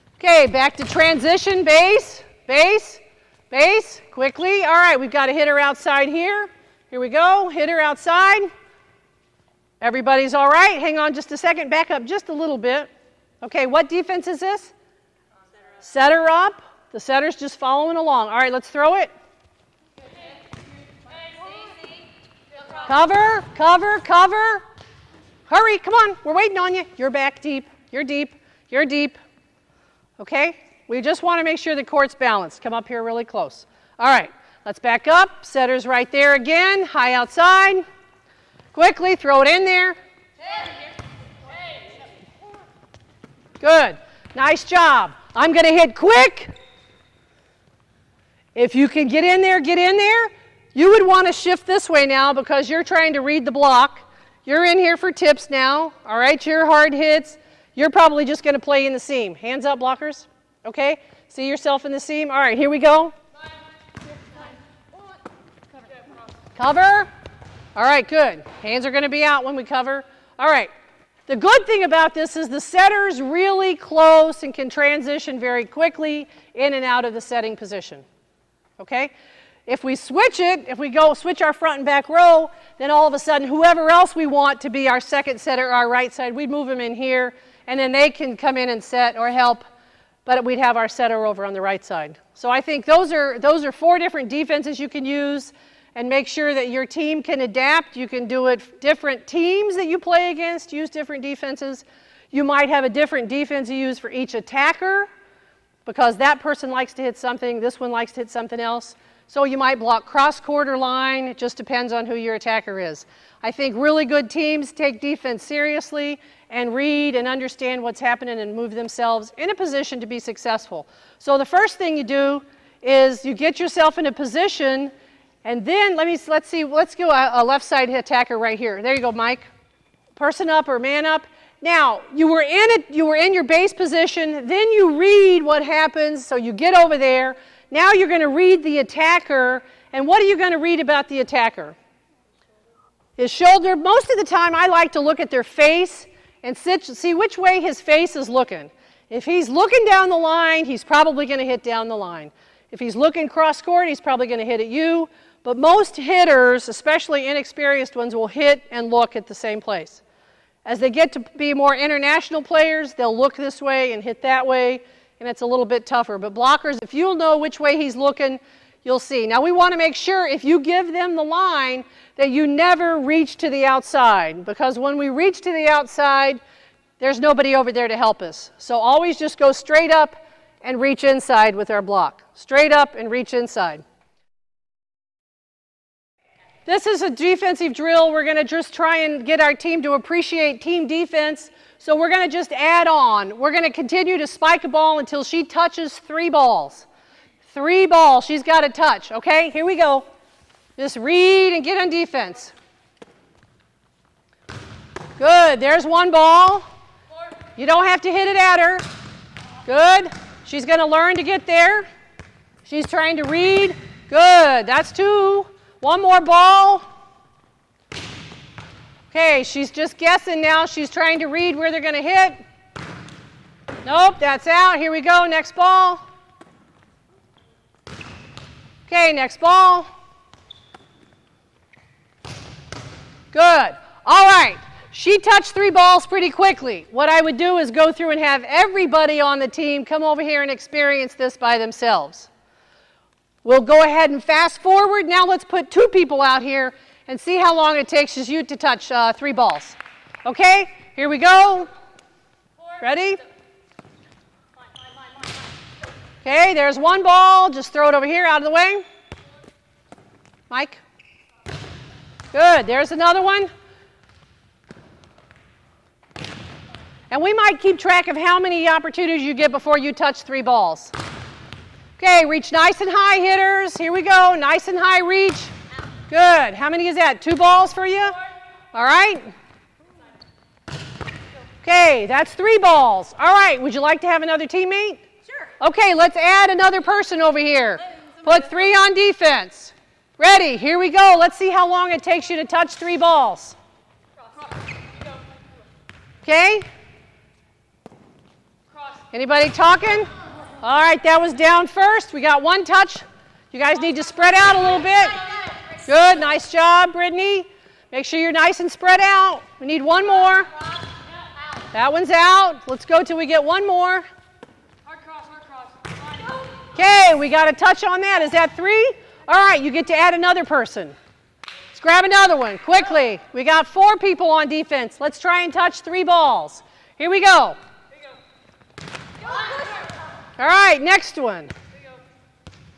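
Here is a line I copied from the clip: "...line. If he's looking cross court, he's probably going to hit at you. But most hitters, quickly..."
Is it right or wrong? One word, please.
wrong.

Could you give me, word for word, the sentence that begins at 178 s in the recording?
So always just go straight up and reach inside with our block.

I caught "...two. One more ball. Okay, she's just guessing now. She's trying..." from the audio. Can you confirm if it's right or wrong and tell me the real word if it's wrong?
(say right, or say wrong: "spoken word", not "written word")
right.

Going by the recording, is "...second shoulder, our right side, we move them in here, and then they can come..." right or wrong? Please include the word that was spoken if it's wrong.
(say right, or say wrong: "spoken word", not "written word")
wrong: "setter", not "shoulder".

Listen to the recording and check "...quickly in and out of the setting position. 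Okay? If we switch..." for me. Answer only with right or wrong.
right.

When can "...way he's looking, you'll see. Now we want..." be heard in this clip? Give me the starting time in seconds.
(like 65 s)
167 s.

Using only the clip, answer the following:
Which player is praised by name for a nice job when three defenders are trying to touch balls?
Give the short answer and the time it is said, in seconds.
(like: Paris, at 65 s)
Brittany, at 306 s.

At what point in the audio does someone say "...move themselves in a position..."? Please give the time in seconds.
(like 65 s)
118 s.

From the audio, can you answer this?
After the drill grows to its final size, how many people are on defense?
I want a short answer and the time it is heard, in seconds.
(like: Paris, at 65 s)
4, at 323 s.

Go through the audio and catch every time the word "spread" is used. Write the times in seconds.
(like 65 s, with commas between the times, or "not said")
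304 s, 308 s.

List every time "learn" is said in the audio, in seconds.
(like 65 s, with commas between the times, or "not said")
210 s.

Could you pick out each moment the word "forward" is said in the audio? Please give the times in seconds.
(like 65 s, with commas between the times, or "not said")
244 s.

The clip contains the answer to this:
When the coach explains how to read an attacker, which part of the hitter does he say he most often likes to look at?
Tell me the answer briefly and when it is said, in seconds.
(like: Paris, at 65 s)
Their face, at 145 s.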